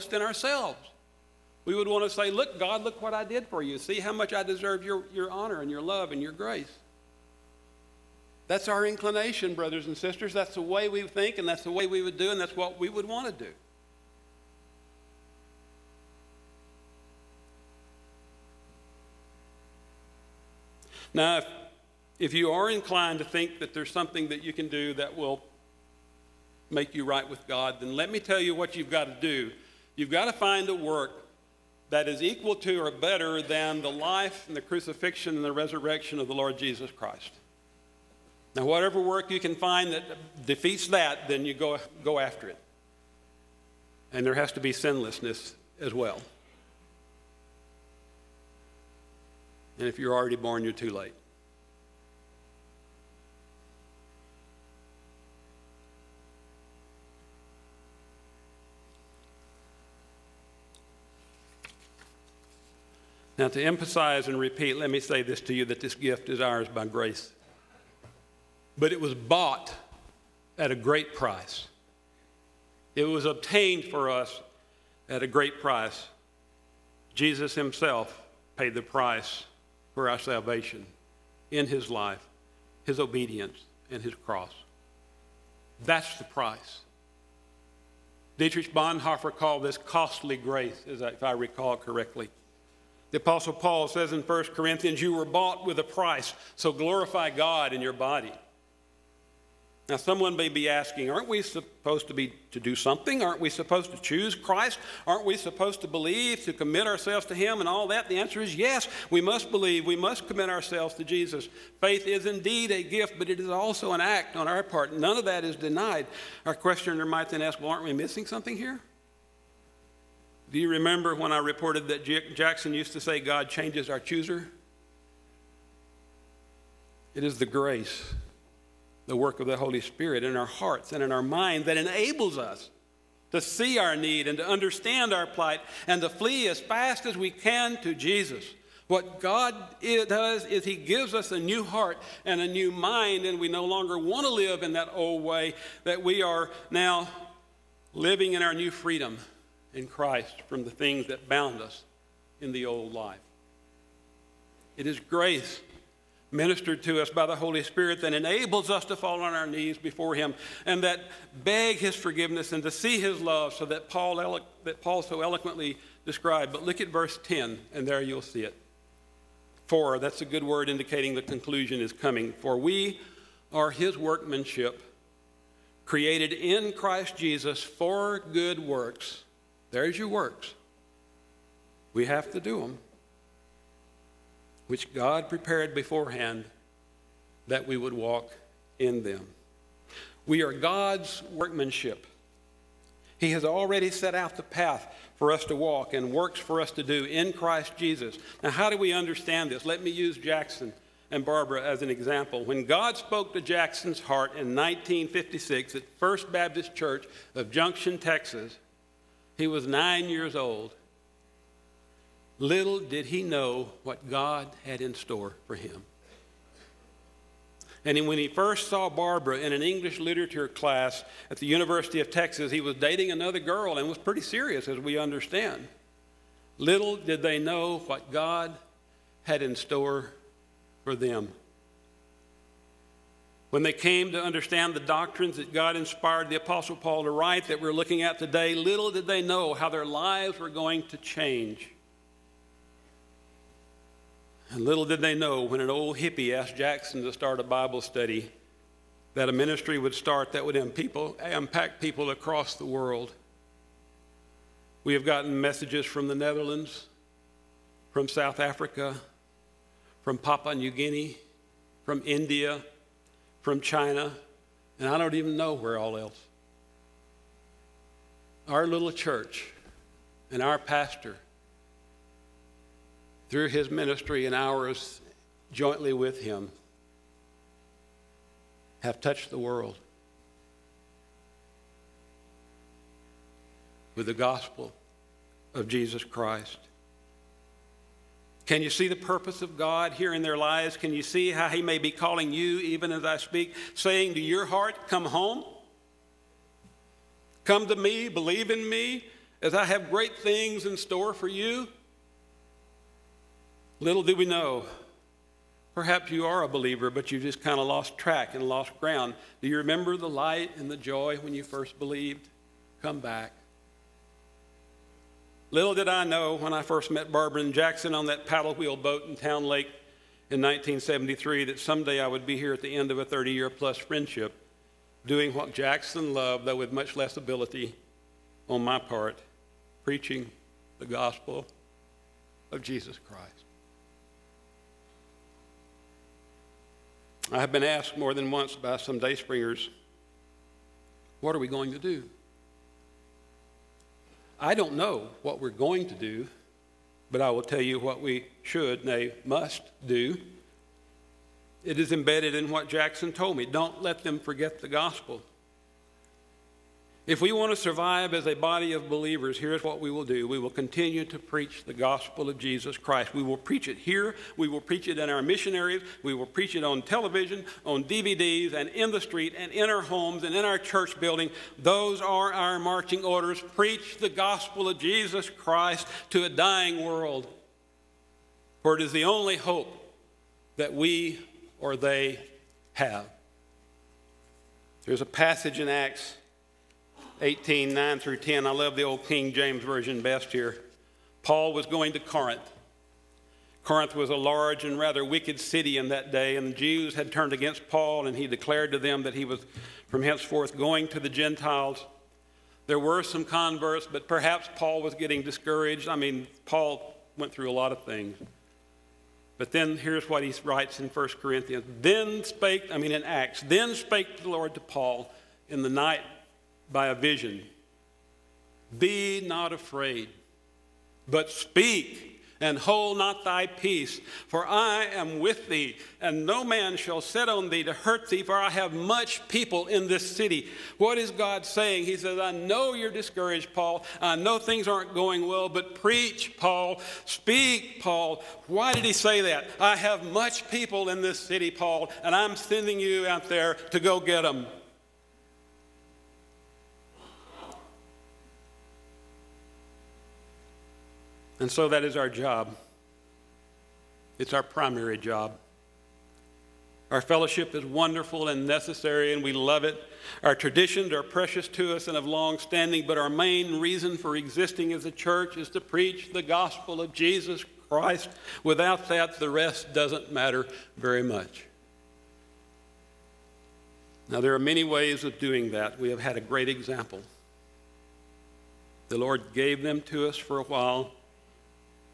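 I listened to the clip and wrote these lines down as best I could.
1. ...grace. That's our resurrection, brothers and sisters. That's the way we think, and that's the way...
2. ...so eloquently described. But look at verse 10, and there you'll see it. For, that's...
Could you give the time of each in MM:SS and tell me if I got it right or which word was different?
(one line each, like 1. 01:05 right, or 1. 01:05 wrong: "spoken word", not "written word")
1. 00:06 wrong: "inclination", not "resurrection"
2. 02:45 right.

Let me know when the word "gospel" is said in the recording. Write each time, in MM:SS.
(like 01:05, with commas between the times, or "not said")
04:44, 05:30, 05:54, 06:01, 06:14, 07:46.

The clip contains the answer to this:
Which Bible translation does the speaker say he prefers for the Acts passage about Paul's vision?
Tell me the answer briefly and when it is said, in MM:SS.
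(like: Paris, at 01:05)
King James Version, at 06:29.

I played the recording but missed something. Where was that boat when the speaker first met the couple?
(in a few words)
Town Lake.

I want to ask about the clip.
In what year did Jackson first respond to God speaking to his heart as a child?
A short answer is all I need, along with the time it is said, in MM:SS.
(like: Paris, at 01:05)
1956, at 03:24.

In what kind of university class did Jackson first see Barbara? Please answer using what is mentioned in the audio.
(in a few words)
English literature.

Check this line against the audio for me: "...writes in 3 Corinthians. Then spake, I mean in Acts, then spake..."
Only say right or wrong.
wrong.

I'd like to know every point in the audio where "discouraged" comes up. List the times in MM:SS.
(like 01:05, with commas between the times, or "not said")
06:45, 07:12.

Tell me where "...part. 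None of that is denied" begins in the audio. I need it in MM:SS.
01:54.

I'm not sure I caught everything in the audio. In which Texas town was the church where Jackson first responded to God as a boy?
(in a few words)
Junction, Texas.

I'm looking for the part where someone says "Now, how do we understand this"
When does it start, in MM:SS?
03:18.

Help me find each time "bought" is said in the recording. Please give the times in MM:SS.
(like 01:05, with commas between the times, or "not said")
01:09, 01:35.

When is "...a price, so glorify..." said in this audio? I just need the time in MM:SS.
01:35.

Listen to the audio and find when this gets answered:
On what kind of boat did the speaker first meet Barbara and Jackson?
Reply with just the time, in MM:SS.
05:18.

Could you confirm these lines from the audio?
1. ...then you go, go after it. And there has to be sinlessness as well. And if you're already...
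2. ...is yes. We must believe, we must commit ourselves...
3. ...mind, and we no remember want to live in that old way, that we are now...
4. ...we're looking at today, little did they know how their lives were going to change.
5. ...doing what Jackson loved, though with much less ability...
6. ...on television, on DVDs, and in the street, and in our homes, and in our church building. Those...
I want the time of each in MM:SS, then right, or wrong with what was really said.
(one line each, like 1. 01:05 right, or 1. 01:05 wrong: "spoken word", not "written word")
1. 00:41 right
2. 01:48 right
3. 02:22 wrong: "longer", not "remember"
4. 03:57 right
5. 05:25 right
6. 06:06 right.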